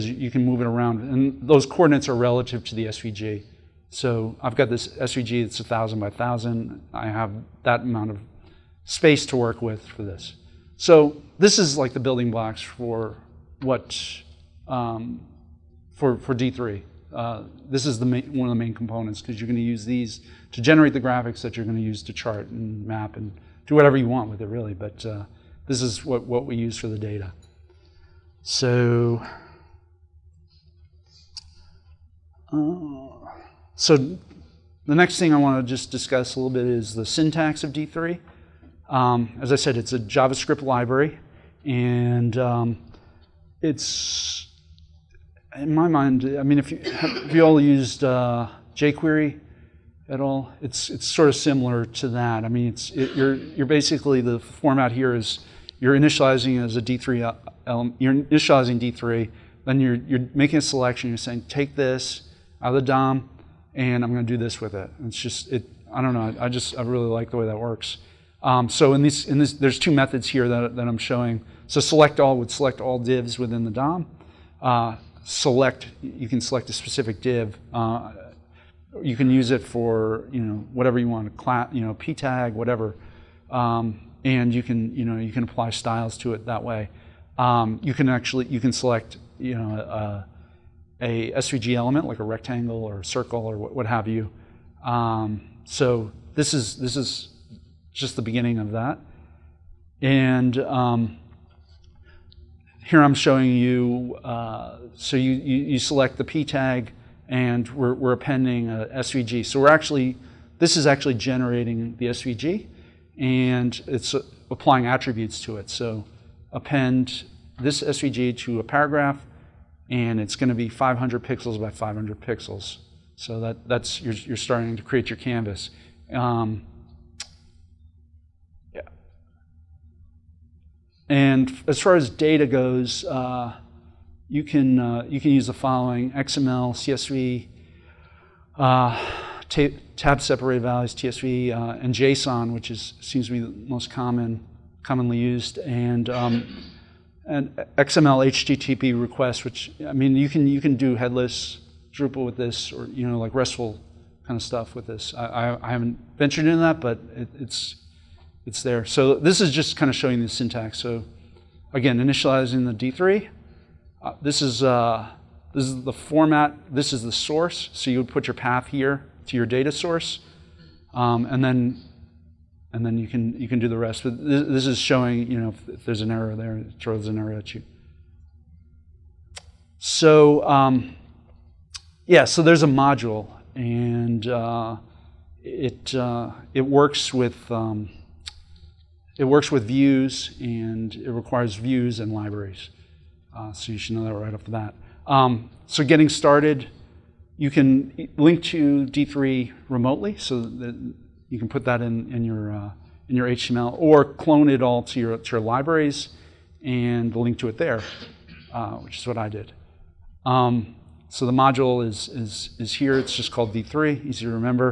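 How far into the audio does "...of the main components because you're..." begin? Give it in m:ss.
0:18.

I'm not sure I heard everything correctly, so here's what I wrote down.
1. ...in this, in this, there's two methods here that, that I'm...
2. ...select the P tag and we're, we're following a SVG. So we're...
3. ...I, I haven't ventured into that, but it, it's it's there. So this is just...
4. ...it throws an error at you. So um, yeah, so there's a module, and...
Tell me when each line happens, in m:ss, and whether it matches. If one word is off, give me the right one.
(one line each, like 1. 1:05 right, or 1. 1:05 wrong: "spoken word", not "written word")
1. 1:08 right
2. 1:45 wrong: "appending", not "following"
3. 2:35 right
4. 2:56 right.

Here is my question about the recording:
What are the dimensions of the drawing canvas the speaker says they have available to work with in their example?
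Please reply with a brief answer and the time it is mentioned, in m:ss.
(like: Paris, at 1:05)
1,000 by 1,000, at 0:05.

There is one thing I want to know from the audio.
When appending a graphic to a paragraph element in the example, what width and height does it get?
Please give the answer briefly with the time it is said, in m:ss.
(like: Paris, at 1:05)
500 by 500 pixels, at 2:00.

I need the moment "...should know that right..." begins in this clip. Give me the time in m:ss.
3:13.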